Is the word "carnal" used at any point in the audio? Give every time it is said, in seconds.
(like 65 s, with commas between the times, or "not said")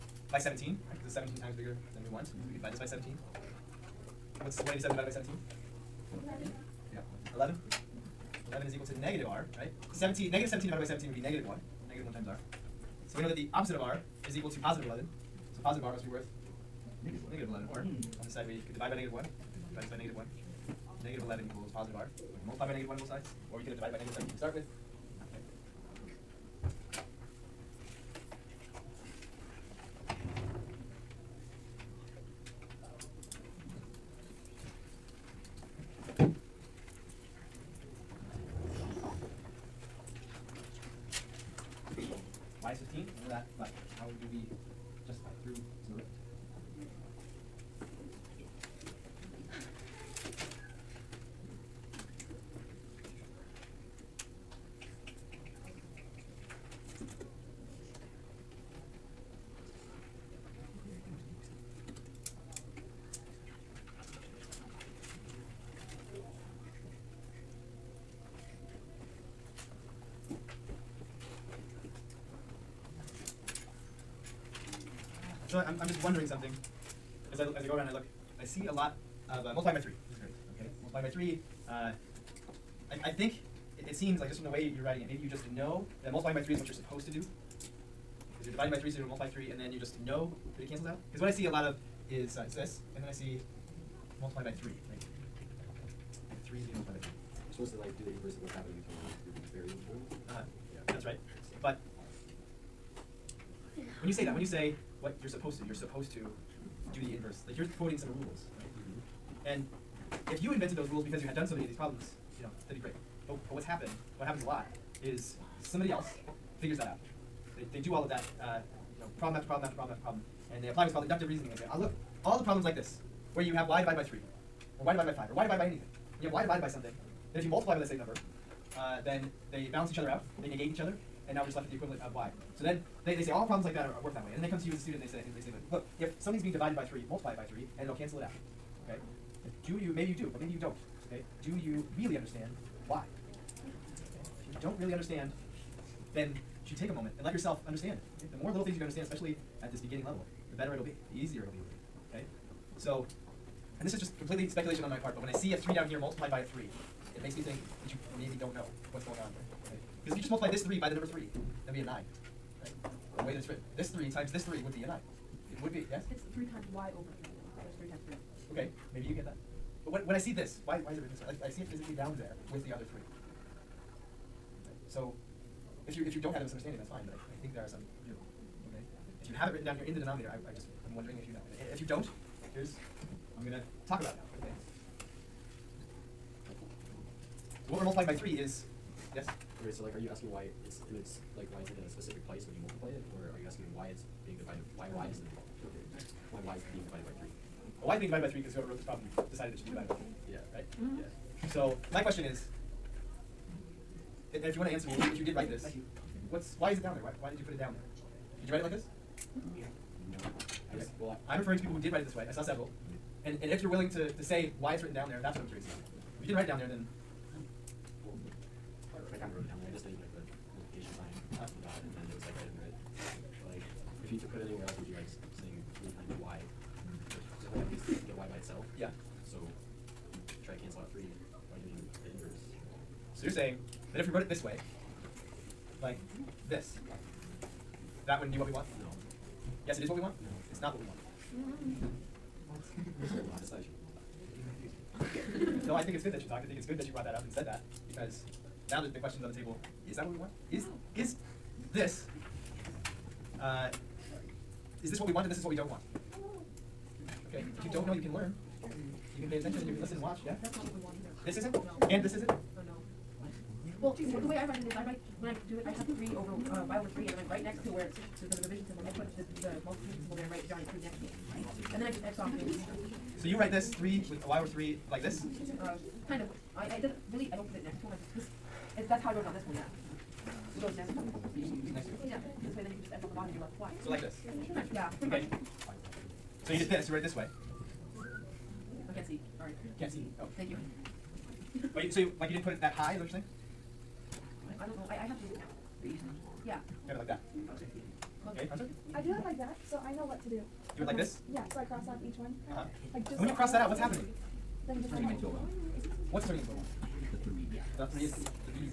not said.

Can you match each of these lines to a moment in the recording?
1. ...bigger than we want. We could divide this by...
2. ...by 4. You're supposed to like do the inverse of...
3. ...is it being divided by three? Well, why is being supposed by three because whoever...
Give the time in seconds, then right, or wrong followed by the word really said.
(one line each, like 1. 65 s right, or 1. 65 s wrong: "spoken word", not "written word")
1. 1 s right
2. 96 s wrong: "3", not "4"
3. 196 s wrong: "divided", not "supposed".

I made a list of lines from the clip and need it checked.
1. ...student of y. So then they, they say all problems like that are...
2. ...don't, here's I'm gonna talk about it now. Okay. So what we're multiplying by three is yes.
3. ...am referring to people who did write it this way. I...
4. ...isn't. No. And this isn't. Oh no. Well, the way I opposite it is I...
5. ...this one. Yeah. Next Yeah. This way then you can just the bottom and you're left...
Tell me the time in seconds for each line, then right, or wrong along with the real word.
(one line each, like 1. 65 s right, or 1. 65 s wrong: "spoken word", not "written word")
1. 131 s wrong: "equivalent", not "student"
2. 181 s right
3. 211 s right
4. 261 s wrong: "write", not "opposite"
5. 279 s right.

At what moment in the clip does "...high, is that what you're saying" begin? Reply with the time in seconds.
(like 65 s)
292 s.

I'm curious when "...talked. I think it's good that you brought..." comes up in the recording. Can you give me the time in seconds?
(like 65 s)
246 s.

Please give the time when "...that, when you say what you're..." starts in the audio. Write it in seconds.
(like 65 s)
104 s.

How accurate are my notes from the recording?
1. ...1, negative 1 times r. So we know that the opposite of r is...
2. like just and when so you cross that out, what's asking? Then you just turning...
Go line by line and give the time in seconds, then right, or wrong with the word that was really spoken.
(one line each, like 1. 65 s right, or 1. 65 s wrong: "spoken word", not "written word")
1. 11 s right
2. 302 s wrong: "happening", not "asking".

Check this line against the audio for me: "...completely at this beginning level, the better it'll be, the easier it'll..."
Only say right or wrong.
wrong.